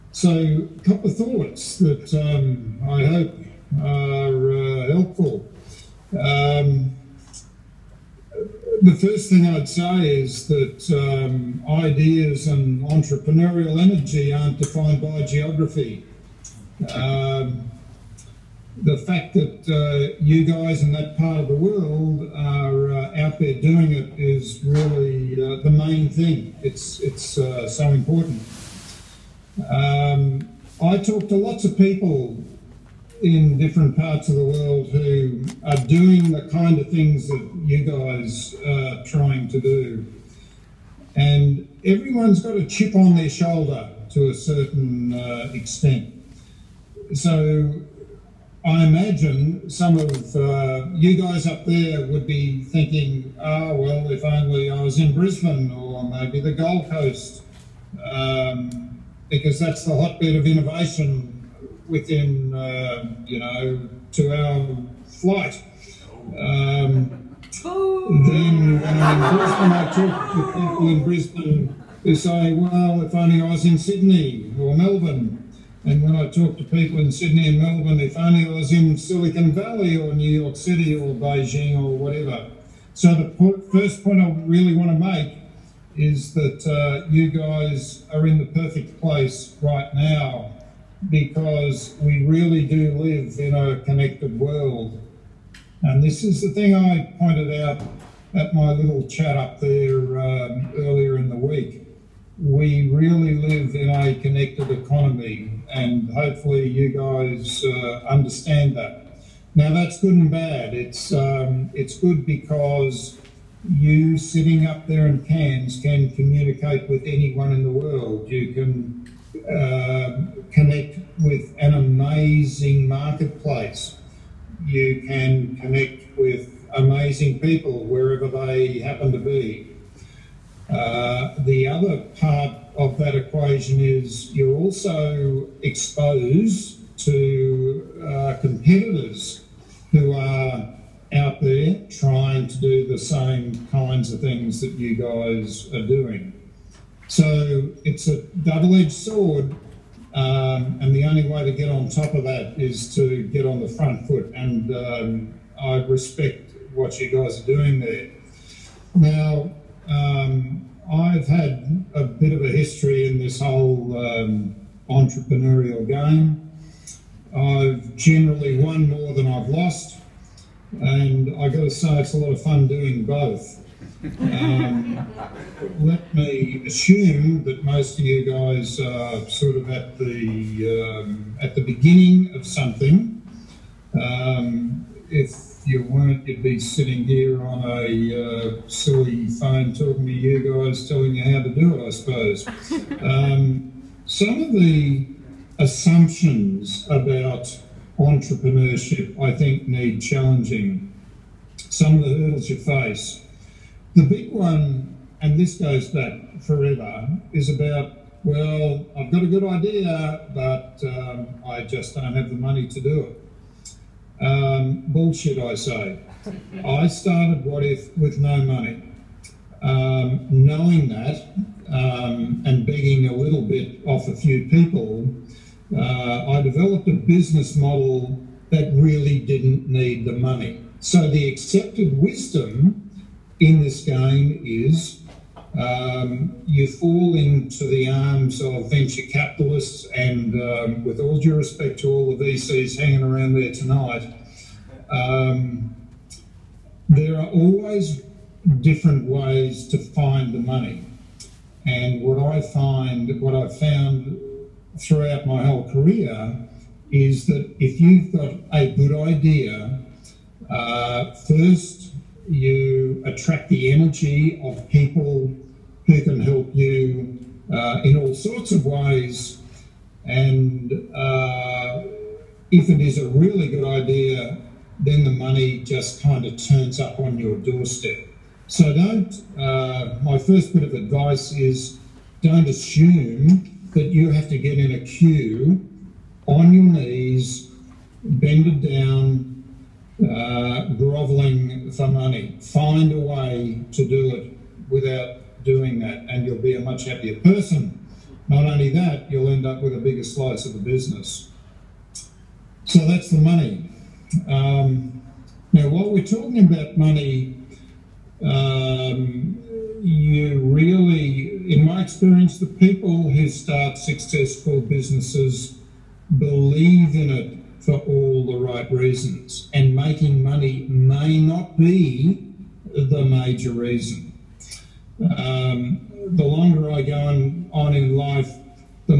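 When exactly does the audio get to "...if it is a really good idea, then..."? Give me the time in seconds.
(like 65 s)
272 s.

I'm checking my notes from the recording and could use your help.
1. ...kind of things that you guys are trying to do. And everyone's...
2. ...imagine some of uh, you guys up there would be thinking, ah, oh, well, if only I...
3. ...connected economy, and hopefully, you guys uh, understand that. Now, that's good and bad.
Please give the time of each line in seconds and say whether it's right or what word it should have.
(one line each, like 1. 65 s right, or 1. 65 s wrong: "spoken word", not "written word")
1. 36 s right
2. 48 s right
3. 104 s right.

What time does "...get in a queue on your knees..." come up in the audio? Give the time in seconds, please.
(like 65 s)
284 s.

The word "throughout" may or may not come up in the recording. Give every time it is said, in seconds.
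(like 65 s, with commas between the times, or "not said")
254 s.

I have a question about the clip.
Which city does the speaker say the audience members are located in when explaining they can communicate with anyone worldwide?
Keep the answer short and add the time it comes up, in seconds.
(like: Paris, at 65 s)
Cairns, at 115 s.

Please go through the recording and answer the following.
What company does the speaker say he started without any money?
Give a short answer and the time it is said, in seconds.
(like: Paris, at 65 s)
Wotif, at 217 s.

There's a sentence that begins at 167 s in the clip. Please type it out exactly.
I've generally won more than I've lost and I've got to say it's a lot of fun doing both.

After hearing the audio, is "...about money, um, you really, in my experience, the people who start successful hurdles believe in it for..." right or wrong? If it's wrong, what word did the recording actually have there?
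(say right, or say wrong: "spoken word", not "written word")
wrong: "businesses", not "hurdles".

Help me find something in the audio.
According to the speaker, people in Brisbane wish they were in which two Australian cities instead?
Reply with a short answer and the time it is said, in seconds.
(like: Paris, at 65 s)
Sydney or Melbourne, at 73 s.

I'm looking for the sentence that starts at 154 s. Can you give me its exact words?
And um, I respect what you guys are doing there.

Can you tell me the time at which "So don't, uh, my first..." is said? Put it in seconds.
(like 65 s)
278 s.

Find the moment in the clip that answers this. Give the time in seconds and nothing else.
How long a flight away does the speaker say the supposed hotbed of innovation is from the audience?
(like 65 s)
64 s.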